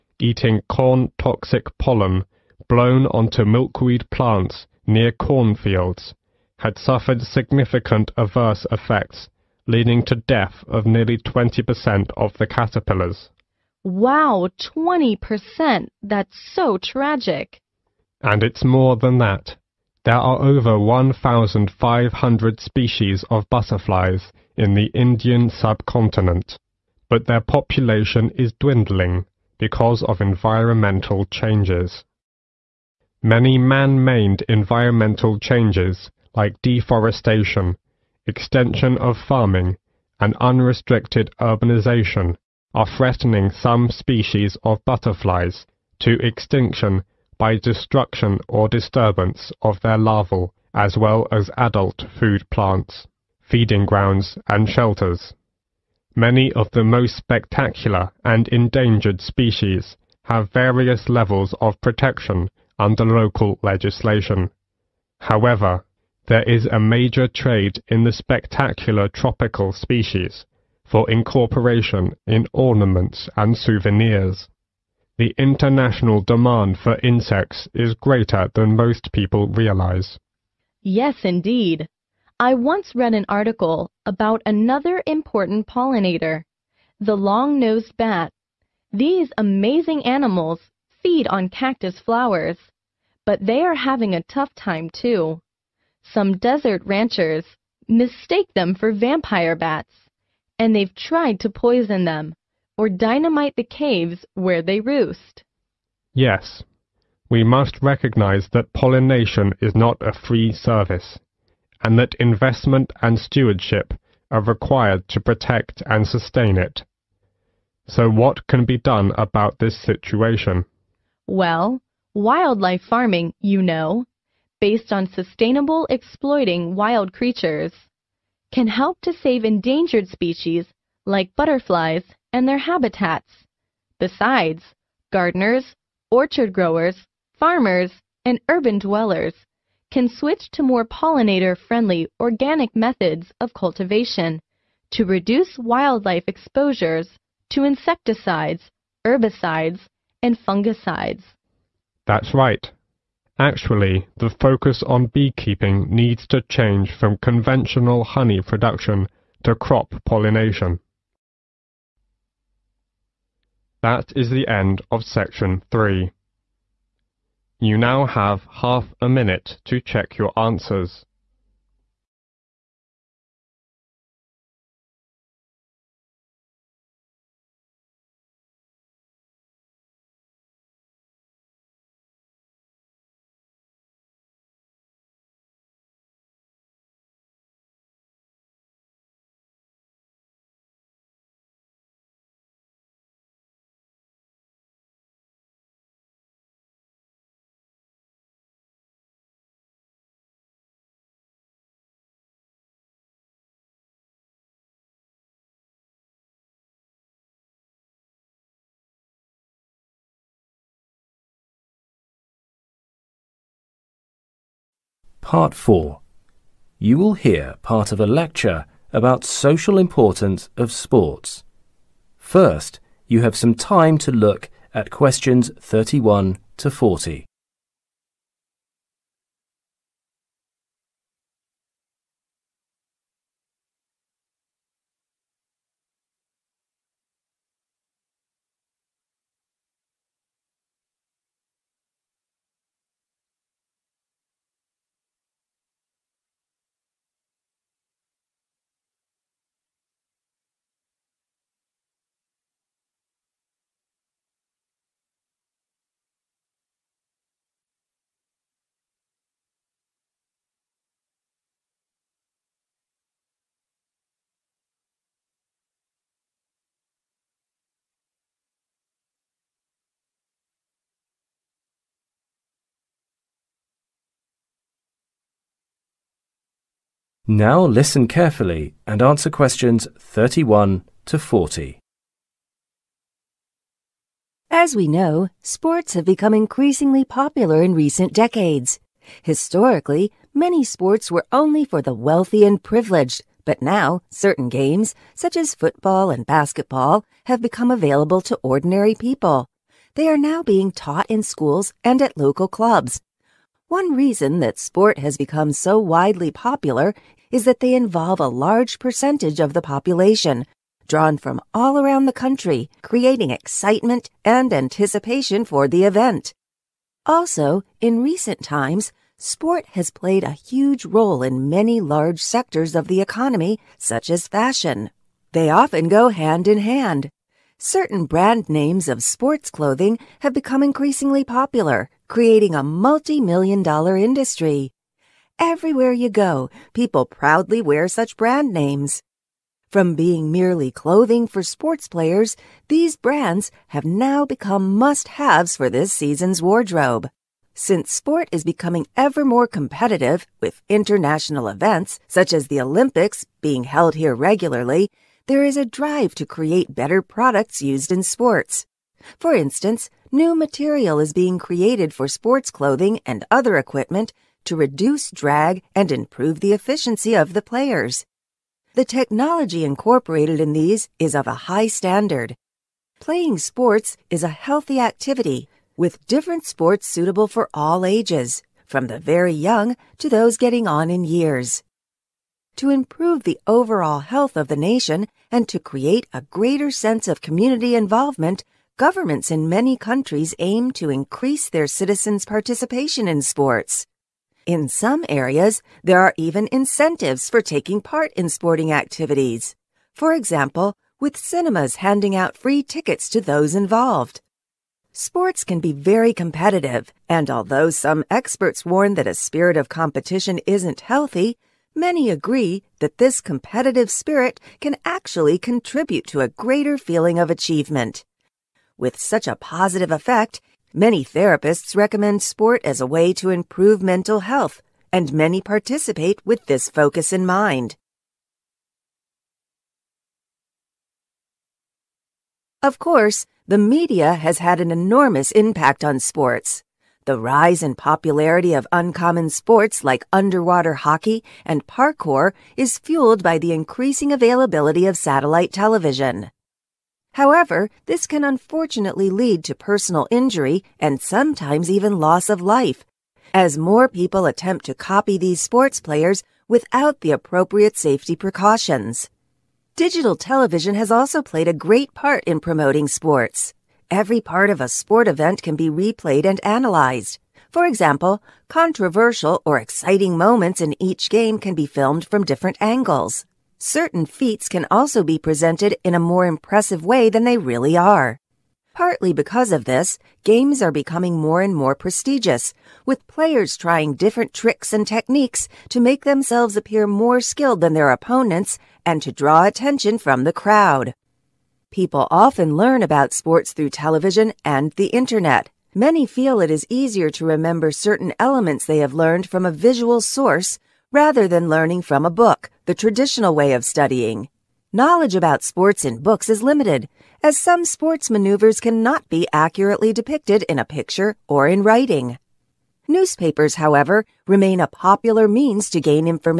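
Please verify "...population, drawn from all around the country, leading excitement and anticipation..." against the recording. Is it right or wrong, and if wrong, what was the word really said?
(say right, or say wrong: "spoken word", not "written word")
wrong: "creating", not "leading".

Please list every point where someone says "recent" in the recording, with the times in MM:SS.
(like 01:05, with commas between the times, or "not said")
04:47, 05:18.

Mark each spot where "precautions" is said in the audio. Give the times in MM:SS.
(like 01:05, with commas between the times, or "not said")
07:38.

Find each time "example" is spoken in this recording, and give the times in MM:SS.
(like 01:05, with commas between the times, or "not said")
06:40, 07:47.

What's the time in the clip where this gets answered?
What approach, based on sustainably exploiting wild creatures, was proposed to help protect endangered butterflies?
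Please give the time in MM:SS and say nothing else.
02:02.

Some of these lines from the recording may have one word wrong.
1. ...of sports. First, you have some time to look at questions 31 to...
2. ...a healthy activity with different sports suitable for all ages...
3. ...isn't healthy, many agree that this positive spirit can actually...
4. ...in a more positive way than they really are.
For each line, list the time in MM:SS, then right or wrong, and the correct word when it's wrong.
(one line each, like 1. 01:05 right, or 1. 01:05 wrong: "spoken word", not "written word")
1. 03:40 right
2. 06:14 right
3. 06:50 wrong: "competitive", not "positive"
4. 07:55 wrong: "impressive", not "positive".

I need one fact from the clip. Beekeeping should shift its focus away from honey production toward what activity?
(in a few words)
crop pollination.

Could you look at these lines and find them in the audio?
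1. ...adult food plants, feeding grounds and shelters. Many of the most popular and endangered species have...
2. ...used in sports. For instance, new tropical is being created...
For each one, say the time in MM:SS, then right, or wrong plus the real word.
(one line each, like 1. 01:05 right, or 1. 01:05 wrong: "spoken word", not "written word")
1. 00:51 wrong: "spectacular", not "popular"
2. 05:57 wrong: "material", not "tropical".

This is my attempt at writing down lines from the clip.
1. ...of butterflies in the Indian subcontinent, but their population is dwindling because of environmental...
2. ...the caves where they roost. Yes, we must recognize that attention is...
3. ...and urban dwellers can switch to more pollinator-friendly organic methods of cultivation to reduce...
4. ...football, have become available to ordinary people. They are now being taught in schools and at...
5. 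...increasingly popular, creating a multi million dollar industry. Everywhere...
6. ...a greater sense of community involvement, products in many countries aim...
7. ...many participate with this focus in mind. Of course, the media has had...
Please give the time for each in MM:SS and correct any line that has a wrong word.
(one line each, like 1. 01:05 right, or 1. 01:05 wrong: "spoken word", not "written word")
1. 00:23 right
2. 01:43 wrong: "pollination", not "attention"
3. 02:18 right
4. 04:56 wrong: "basketball", not "football"
5. 05:30 right
6. 06:26 wrong: "governments", not "products"
7. 07:05 right.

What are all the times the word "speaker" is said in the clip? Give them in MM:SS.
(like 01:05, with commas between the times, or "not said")
not said.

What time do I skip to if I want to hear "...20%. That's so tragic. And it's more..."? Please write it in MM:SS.
00:14.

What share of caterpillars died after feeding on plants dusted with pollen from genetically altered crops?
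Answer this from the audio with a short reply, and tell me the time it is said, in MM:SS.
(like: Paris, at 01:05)
20%, at 00:10.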